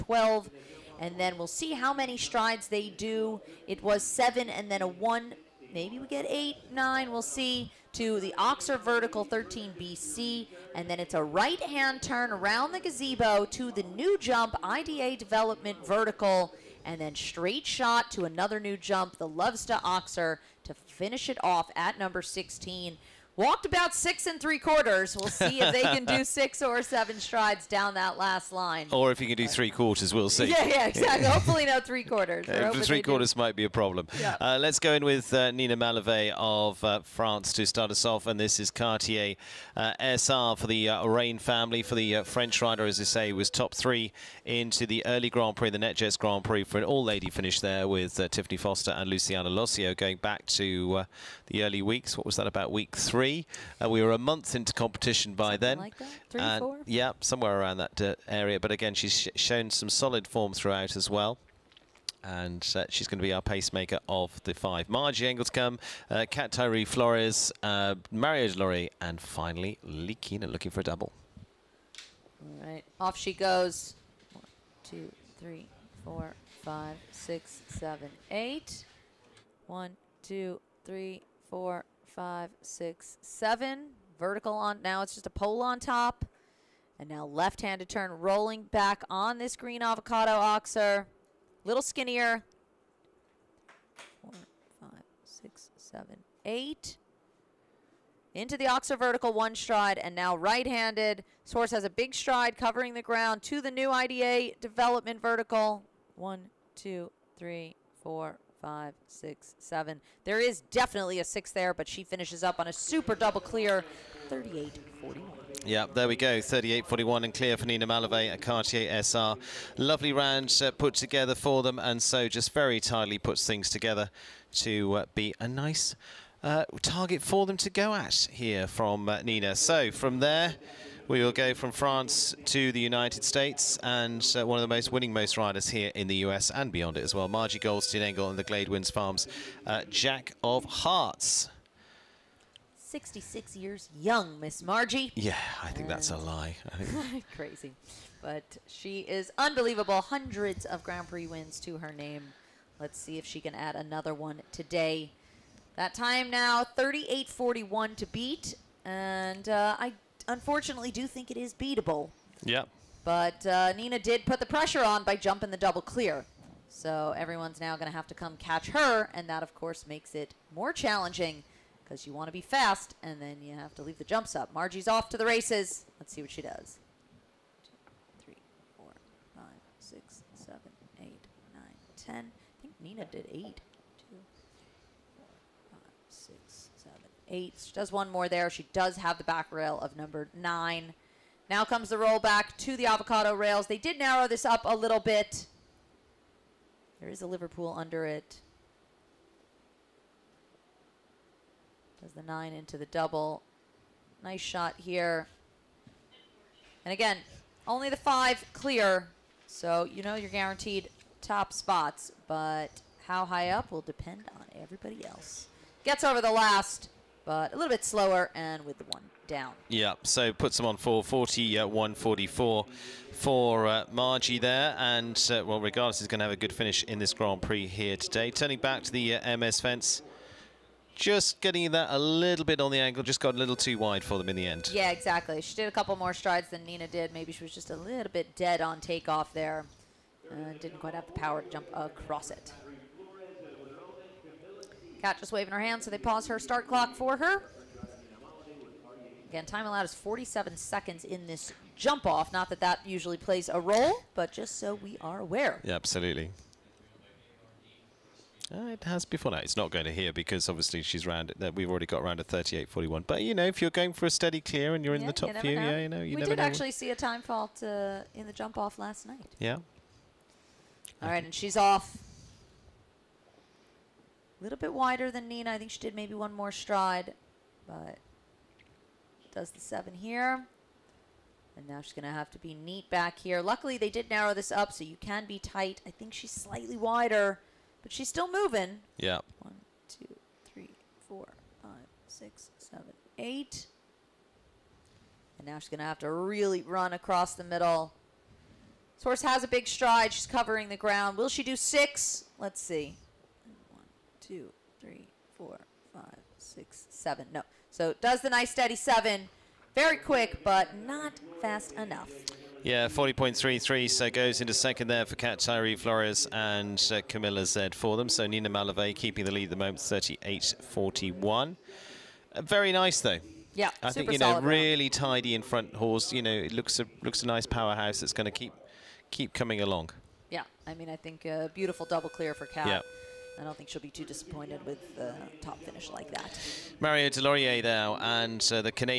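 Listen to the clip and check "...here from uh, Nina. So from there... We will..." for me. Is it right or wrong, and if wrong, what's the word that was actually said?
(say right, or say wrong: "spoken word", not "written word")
right.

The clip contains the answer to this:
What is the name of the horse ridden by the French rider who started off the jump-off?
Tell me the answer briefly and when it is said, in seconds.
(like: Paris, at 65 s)
Cartier SR, at 38 s.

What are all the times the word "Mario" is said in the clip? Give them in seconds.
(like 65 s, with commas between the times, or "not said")
68 s, 336 s.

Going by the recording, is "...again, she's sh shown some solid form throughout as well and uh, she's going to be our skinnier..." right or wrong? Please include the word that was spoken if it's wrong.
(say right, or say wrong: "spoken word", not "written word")
wrong: "pacemaker", not "skinnier".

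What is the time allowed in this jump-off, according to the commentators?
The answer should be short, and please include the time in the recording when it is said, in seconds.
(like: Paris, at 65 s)
47 seconds, at 249 s.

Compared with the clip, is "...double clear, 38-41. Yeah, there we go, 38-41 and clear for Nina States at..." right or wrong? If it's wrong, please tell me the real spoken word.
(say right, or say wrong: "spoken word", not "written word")
wrong: "Mallevaey", not "States".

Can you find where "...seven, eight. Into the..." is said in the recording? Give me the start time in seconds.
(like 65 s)
95 s.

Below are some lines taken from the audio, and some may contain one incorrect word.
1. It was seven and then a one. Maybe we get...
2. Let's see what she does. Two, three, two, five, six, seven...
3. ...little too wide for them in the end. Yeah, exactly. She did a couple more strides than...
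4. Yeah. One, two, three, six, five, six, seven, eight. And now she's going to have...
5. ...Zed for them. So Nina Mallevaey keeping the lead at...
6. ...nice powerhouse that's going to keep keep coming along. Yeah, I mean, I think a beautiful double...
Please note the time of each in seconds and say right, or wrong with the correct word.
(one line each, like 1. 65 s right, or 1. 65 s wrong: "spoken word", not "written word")
1. 3 s right
2. 176 s wrong: "four", not "two"
3. 233 s right
4. 288 s wrong: "four", not "six"
5. 317 s right
6. 327 s right.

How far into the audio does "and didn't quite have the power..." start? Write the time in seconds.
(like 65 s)
240 s.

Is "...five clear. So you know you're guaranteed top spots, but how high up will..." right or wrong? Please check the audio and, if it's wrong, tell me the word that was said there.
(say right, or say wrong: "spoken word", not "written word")
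right.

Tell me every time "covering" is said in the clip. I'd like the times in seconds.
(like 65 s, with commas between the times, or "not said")
102 s, 300 s.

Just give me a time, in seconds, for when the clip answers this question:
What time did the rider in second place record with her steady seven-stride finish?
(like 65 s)
312 s.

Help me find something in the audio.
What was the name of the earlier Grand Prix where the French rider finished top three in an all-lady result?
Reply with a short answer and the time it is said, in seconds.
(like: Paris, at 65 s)
NetJets Grand Prix, at 45 s.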